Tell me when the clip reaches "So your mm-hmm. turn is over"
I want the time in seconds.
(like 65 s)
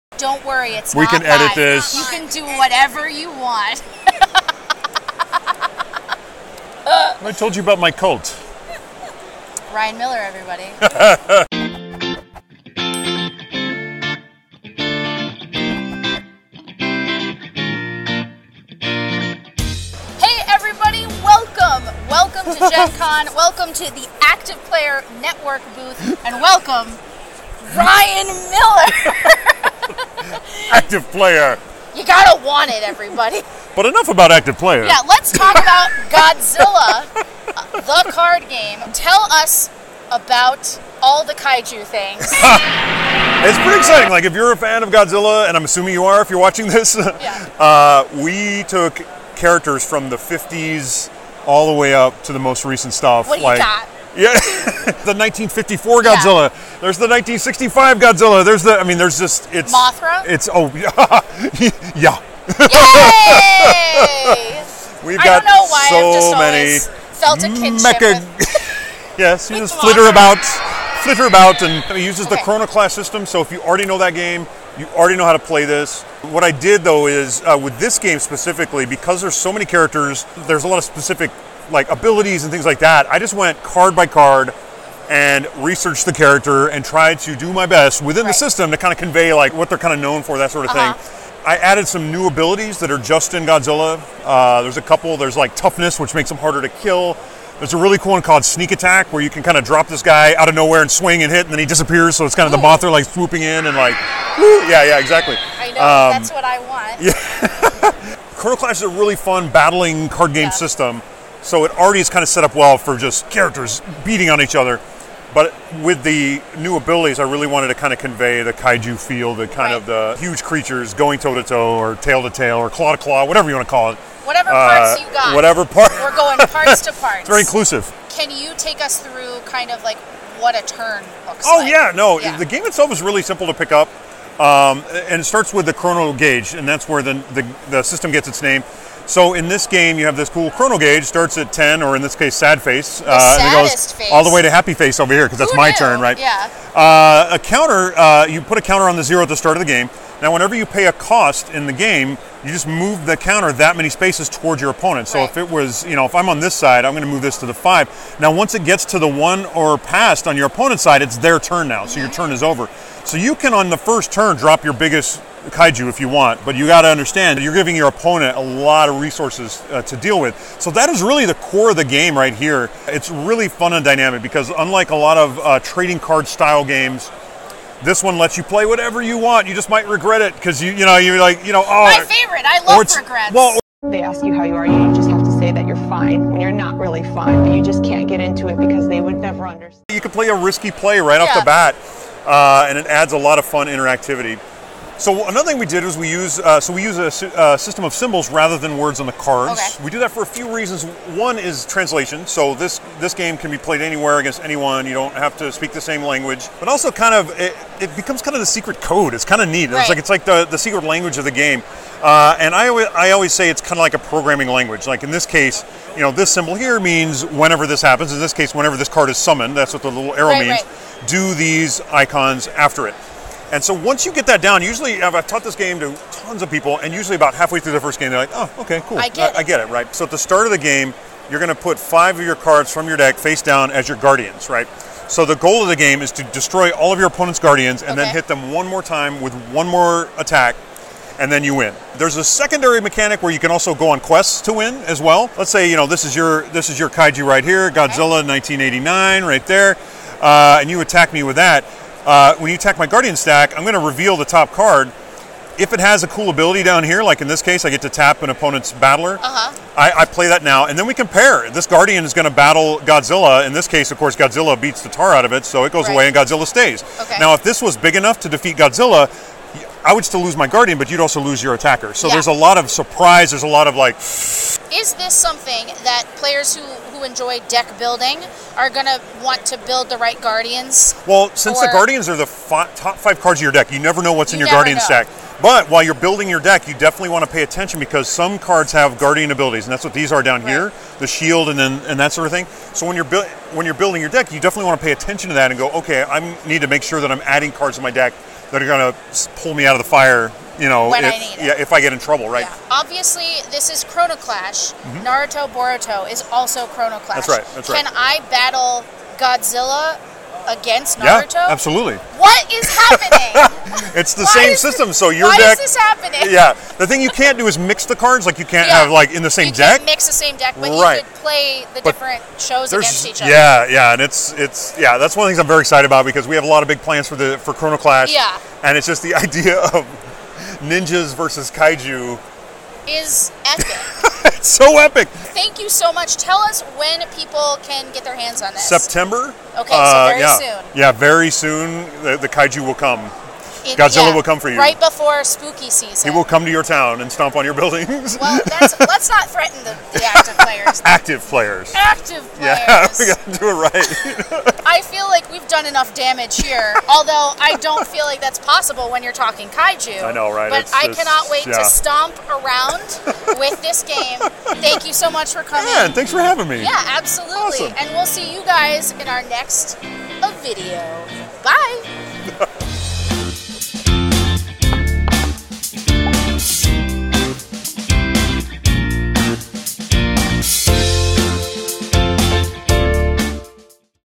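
161 s.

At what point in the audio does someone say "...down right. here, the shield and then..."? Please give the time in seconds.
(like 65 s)
290 s.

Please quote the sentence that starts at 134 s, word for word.
Um, and it starts with the chrono gauge, and that's where the, the, the system gets its name.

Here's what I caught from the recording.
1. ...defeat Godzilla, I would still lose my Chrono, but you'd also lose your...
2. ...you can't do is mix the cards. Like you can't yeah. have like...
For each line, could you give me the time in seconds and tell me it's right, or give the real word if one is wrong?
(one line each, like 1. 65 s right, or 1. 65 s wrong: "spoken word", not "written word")
1. 268 s wrong: "Guardian", not "Chrono"
2. 317 s right.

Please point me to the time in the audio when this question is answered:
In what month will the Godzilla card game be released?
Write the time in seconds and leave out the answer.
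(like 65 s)
338 s.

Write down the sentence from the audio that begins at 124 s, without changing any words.
Whatever uh, parts uh, you got.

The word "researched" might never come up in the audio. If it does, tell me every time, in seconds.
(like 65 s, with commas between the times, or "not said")
85 s.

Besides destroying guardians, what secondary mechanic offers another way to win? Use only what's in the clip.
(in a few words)
quests.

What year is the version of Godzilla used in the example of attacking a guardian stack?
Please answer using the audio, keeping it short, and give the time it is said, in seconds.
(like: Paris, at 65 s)
1989, at 248 s.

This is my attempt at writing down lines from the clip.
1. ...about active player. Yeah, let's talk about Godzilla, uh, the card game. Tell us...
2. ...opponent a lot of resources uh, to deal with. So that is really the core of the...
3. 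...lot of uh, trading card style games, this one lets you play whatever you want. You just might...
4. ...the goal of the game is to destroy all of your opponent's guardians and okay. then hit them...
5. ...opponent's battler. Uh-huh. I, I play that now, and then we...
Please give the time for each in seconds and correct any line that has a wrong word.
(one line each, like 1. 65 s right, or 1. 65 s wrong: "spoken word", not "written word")
1. 34 s right
2. 167 s right
3. 174 s right
4. 235 s right
5. 258 s right.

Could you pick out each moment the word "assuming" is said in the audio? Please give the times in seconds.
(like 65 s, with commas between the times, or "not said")
45 s.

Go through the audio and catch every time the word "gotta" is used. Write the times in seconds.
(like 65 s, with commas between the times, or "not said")
32 s, 353 s.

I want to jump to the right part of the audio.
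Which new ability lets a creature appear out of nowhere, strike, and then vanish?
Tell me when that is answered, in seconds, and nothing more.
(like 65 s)
98 s.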